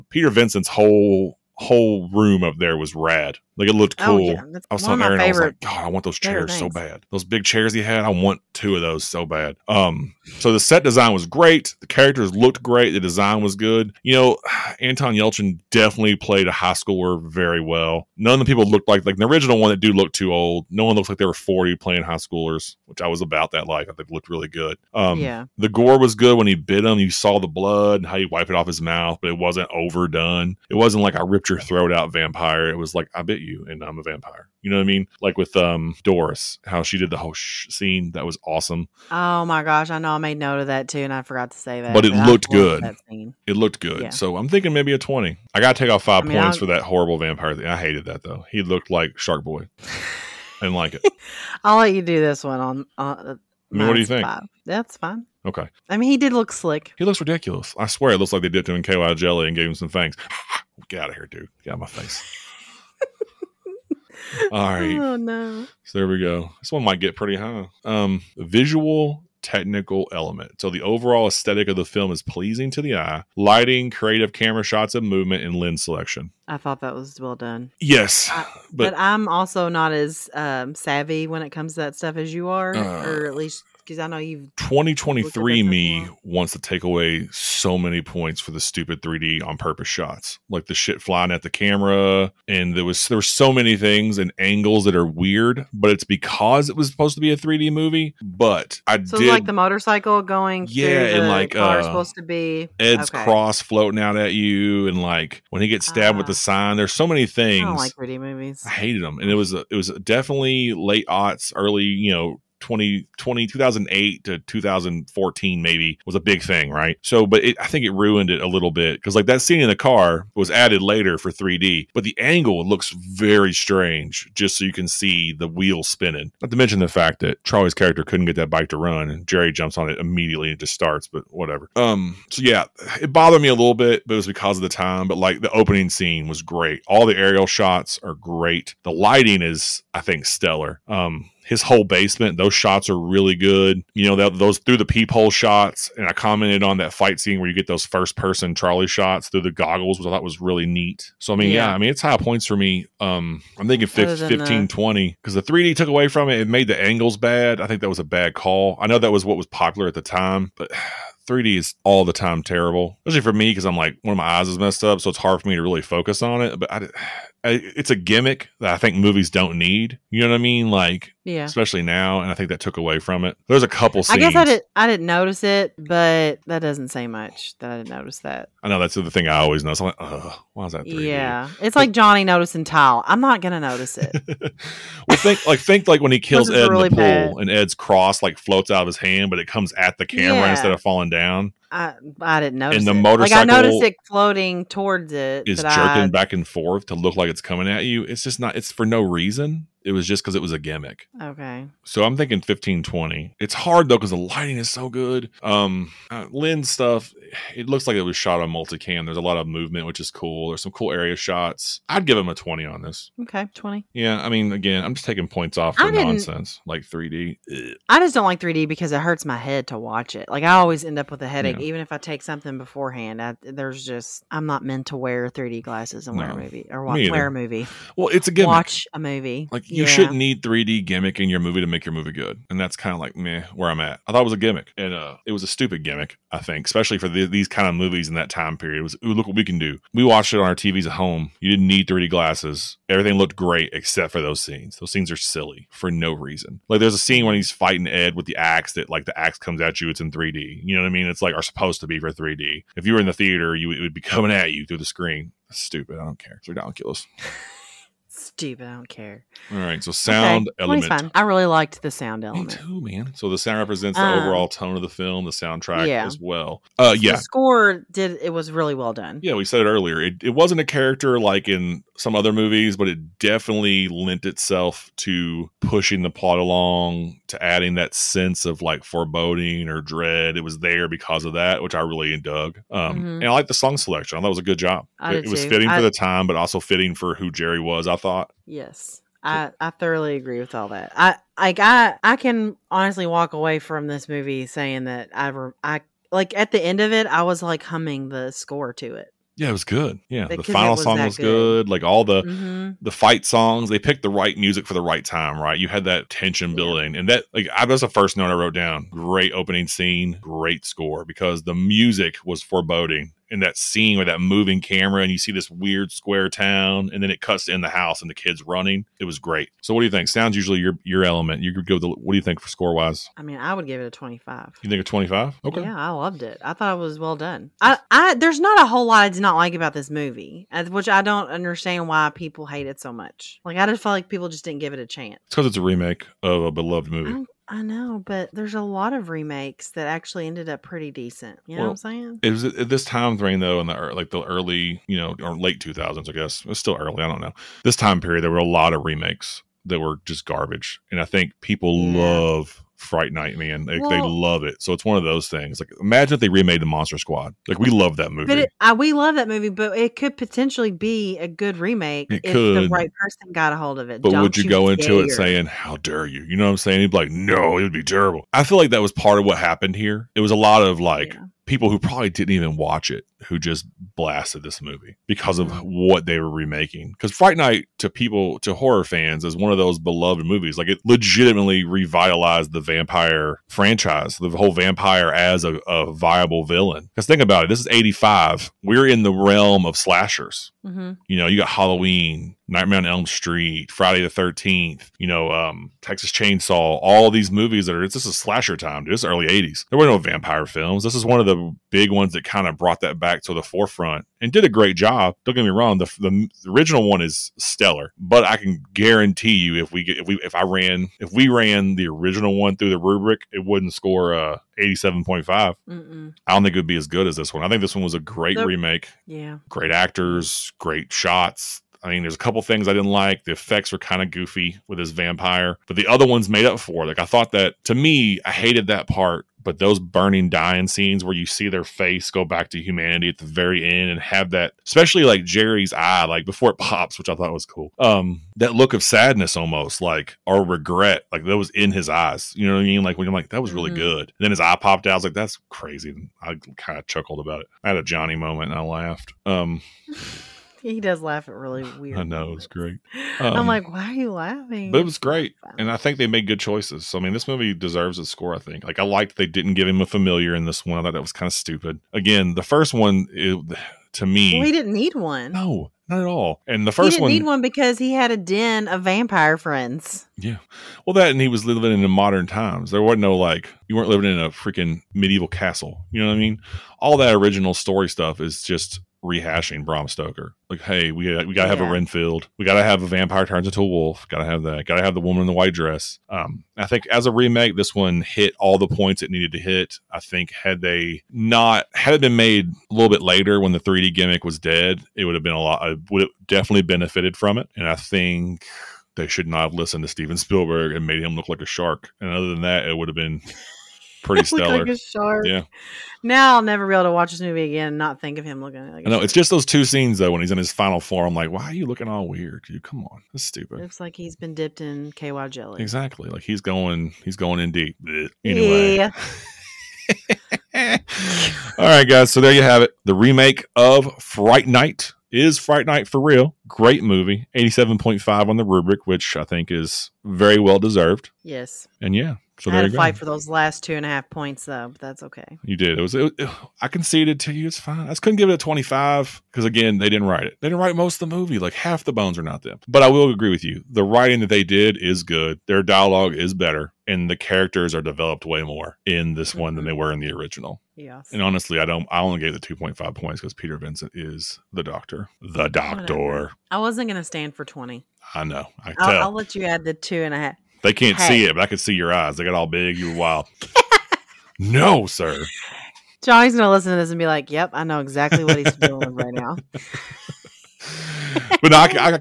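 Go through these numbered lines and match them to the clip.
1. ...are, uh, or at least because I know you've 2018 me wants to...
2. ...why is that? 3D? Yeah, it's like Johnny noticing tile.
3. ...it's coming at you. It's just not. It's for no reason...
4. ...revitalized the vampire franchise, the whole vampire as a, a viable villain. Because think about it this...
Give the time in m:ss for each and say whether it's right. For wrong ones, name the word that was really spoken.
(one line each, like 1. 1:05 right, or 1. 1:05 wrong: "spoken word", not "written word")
1. 1:22 wrong: "2023", not "2018"
2. 3:00 right
3. 3:17 right
4. 6:21 right.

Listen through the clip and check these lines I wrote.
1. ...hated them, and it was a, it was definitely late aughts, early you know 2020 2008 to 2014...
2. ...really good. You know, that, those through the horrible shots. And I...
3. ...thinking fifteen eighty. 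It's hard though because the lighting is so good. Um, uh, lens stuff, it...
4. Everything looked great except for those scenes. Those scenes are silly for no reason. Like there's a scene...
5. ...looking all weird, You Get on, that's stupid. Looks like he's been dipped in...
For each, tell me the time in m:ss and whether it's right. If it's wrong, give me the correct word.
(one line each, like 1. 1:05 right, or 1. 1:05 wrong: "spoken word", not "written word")
1. 1:48 right
2. 2:22 wrong: "peephole", not "horrible"
3. 3:22 wrong: "twenty", not "eighty"
4. 4:02 right
5. 8:31 wrong: "Come", not "Get".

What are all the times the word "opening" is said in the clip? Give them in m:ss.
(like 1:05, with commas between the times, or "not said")
2:15, 5:09.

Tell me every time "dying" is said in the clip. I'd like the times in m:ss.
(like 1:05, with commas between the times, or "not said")
7:10.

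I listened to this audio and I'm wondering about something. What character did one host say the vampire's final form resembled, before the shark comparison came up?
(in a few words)
Shark Boy.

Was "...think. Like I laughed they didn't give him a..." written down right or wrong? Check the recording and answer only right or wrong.
wrong.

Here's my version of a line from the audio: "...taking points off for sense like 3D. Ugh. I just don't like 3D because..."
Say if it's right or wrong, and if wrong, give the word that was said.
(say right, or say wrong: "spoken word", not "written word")
wrong: "nonsense", not "sense".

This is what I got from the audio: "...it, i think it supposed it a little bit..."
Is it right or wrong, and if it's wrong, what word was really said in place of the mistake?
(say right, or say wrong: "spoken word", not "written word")
wrong: "ruined", not "supposed".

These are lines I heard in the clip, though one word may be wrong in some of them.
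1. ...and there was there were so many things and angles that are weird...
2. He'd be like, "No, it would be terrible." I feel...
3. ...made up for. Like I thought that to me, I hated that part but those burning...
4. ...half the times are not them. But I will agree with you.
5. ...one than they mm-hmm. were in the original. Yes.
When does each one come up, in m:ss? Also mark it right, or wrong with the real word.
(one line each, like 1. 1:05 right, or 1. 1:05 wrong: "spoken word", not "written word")
1. 1:32 right
2. 6:06 right
3. 7:06 right
4. 9:01 wrong: "bones", not "times"
5. 9:09 right.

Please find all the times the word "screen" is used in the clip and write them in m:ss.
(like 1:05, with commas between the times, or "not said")
4:14.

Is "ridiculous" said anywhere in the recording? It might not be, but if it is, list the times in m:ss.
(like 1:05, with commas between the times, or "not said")
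0:57, 4:16.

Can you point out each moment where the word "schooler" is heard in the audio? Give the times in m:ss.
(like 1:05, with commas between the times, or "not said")
0:16, 0:22.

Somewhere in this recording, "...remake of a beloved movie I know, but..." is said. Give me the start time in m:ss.
5:35.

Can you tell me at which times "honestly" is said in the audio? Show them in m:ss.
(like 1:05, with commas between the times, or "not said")
4:52, 9:11.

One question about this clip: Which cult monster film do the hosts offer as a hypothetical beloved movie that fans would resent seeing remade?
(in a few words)
The Monster Squad.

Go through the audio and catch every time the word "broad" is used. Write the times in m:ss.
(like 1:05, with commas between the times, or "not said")
not said.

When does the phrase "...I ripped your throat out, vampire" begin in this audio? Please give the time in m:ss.
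0:31.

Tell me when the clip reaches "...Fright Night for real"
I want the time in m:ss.
8:45.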